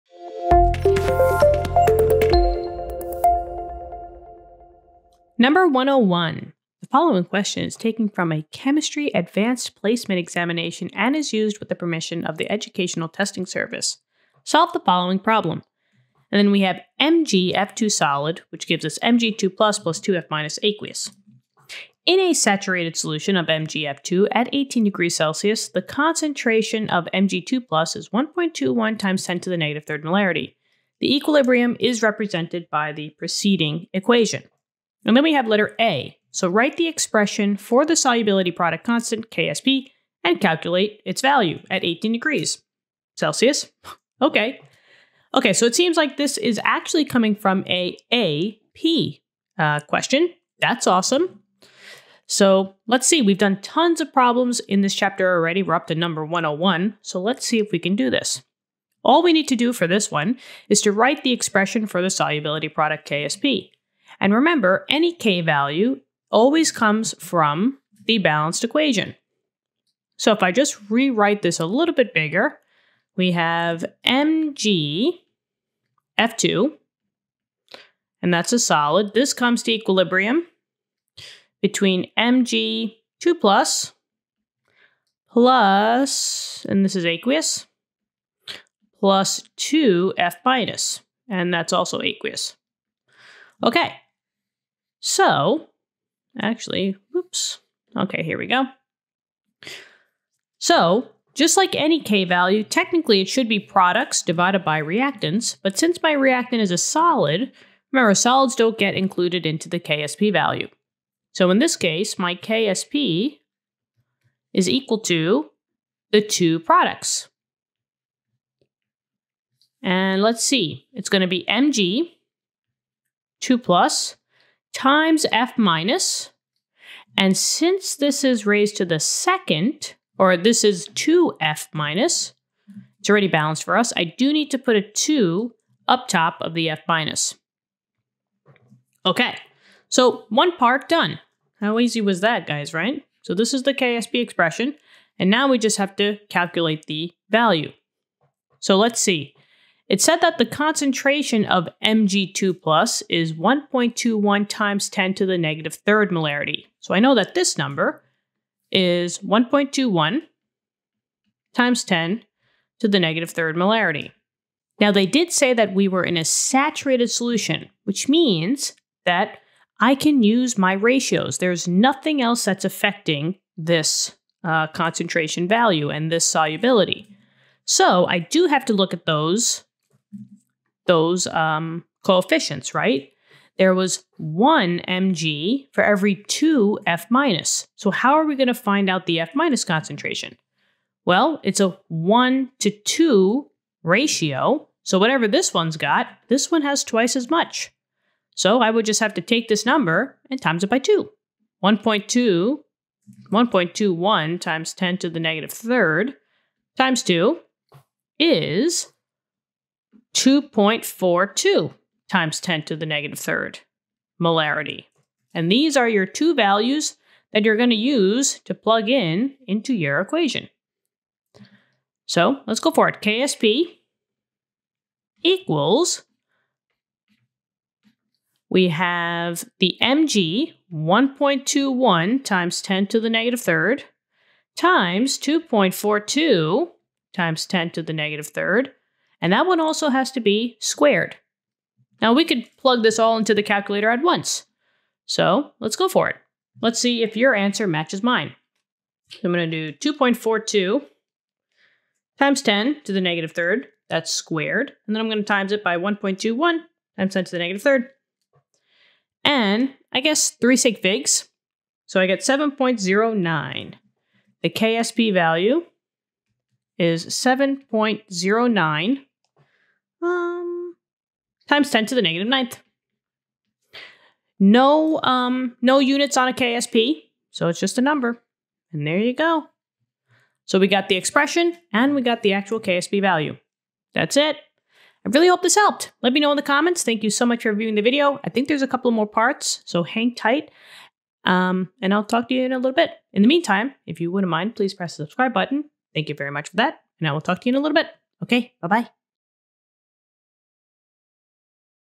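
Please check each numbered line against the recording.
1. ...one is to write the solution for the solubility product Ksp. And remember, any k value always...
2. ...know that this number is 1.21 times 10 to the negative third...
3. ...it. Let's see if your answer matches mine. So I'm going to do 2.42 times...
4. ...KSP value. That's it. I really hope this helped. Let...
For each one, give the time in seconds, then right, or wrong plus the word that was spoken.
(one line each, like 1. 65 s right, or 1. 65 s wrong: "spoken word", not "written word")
1. 60 s wrong: "expression", not "solution"
2. 157 s right
3. 246 s right
4. 282 s right.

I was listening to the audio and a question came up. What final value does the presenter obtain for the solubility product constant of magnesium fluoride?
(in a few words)
7.09 x 10^-9.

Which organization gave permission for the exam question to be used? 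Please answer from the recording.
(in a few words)
Educational Testing Service.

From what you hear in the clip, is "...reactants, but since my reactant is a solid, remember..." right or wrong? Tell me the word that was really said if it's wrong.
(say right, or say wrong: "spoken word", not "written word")
right.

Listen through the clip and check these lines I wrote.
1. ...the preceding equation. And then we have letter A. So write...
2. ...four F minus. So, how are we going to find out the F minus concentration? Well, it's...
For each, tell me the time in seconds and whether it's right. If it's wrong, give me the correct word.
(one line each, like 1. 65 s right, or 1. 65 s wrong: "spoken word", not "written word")
1. 32 s right
2. 186 s wrong: "two", not "four".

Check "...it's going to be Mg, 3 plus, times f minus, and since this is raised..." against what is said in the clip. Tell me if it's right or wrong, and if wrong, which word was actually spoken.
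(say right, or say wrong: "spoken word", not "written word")
wrong: "2", not "3".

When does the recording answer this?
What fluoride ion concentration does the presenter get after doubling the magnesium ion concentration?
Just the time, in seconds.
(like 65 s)
210 s.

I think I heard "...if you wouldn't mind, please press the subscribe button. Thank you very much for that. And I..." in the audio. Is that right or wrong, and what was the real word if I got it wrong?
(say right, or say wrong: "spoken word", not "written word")
right.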